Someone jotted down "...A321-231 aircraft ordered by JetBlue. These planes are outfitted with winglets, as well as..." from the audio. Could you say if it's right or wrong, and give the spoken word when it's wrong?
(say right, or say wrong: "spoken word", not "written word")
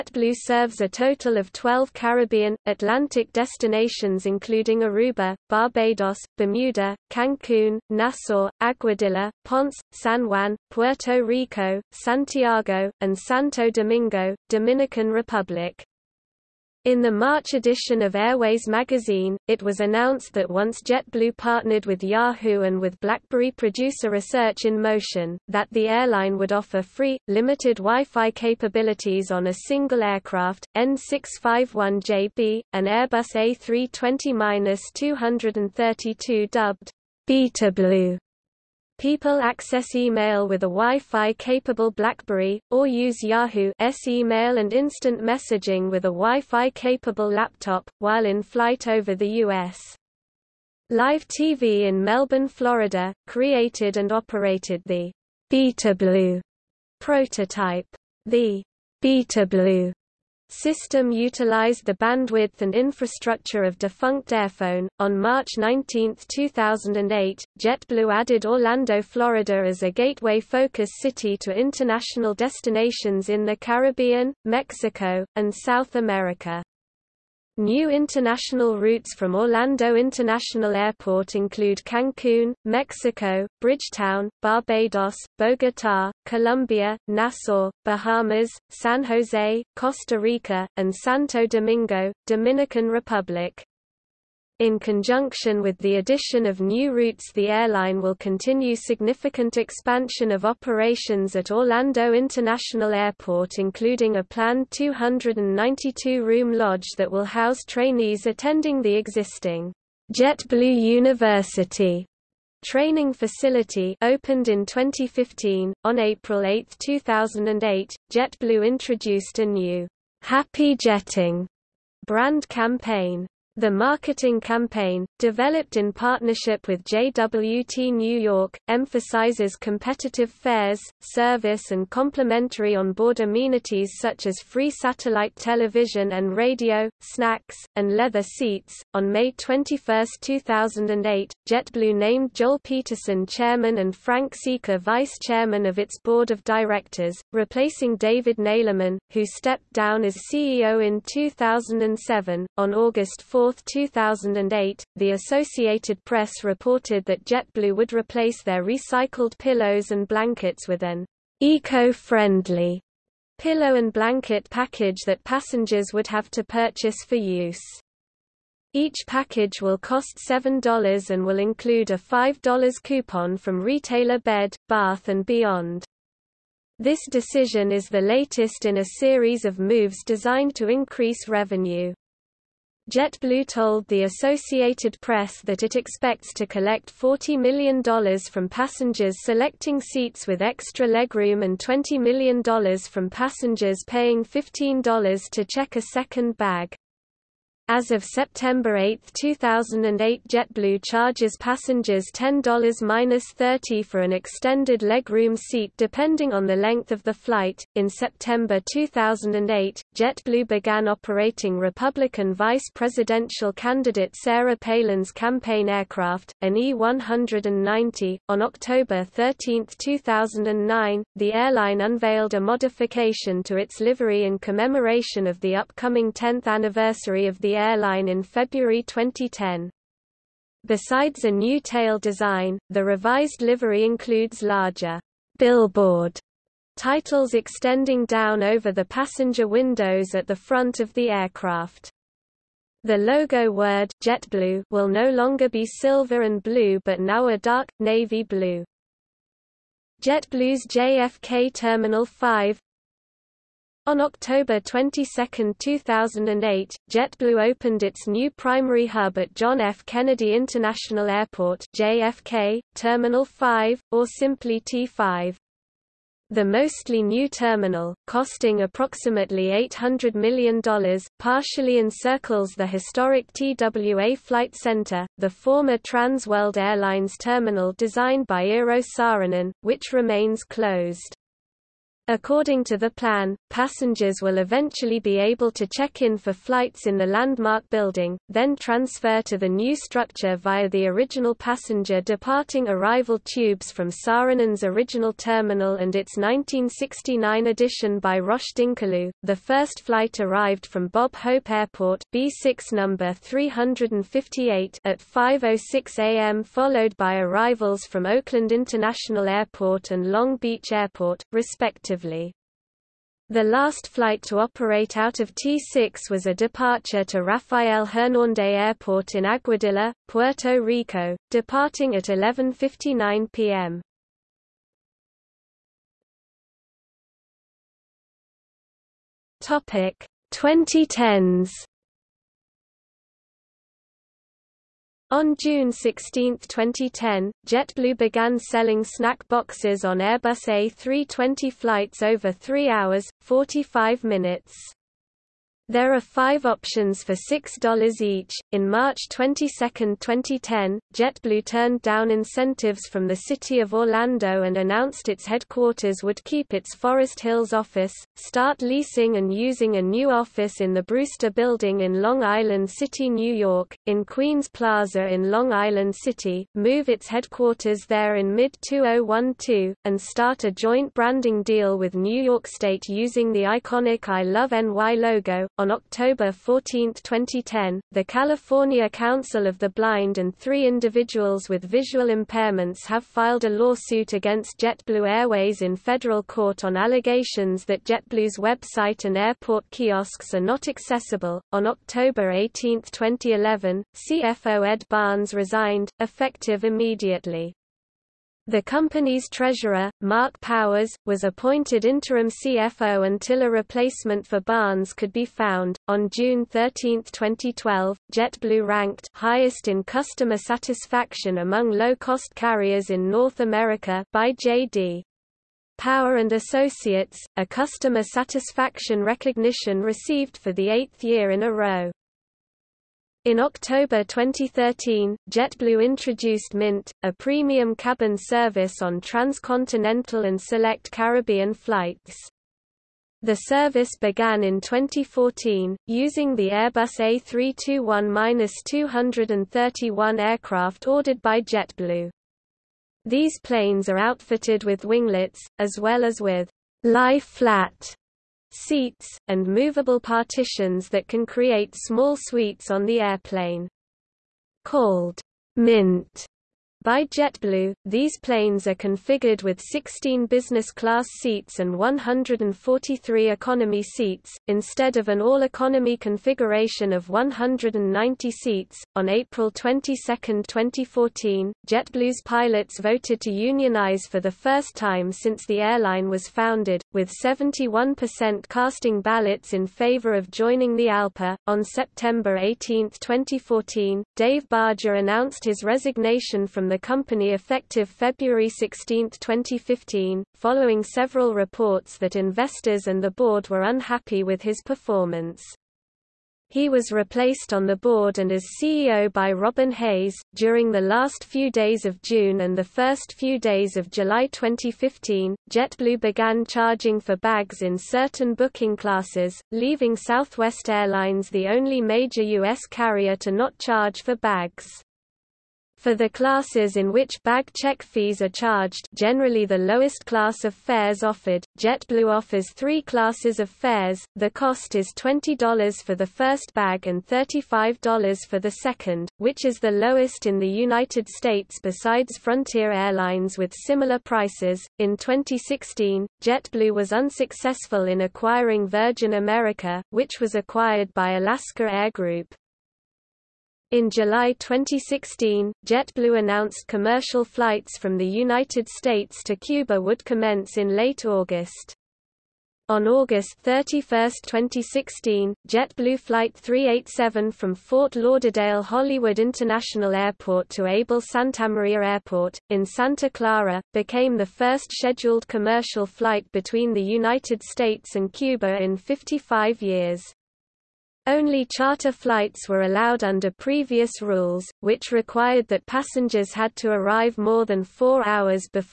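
right.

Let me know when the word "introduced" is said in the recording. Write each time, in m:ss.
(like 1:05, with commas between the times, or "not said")
1:58, 7:05.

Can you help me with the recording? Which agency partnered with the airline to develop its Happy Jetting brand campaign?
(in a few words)
JWT New York.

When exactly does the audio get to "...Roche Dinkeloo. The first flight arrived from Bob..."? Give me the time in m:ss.
4:58.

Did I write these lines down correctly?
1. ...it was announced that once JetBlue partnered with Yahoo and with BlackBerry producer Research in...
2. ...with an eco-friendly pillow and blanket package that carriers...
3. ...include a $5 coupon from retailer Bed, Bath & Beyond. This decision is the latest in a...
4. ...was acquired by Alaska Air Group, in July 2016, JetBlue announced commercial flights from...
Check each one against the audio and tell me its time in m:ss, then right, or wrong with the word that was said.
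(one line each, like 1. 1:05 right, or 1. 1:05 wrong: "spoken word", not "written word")
1. 0:19 right
2. 2:40 wrong: "passengers", not "carriers"
3. 2:51 right
4. 9:00 right.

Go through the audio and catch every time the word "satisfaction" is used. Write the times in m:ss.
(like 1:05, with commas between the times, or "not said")
6:50, 6:58.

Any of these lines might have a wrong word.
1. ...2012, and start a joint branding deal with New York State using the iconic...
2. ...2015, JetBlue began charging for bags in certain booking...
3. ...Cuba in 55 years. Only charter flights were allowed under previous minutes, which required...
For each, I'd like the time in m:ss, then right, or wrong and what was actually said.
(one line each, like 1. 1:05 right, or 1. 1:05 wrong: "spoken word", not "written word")
1. 6:08 right
2. 8:24 right
3. 9:28 wrong: "rules", not "minutes".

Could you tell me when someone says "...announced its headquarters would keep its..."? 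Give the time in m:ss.
5:54.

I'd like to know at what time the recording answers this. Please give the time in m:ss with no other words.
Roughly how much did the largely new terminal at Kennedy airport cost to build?
4:29.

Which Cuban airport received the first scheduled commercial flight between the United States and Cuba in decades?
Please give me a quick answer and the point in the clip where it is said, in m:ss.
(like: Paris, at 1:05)
Abel Santamaria Airport, at 9:20.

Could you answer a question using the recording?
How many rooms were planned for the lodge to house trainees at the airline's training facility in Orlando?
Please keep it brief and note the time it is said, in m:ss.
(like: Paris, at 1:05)
292, at 1:44.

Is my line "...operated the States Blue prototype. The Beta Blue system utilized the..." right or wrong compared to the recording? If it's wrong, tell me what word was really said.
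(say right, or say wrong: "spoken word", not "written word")
wrong: "Beta", not "States".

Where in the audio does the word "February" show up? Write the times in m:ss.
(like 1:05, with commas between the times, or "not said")
3:48, 8:07.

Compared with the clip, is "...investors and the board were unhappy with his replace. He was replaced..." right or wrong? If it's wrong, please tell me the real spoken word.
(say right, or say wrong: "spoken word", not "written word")
wrong: "performance", not "replace".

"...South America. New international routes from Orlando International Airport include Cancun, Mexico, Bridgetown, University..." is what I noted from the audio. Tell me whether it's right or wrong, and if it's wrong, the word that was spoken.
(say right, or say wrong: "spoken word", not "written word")
wrong: "Barbados", not "University".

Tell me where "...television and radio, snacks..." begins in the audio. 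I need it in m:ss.
2:15.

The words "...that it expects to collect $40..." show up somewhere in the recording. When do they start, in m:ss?
3:05.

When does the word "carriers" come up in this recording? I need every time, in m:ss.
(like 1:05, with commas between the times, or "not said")
6:52, 8:32.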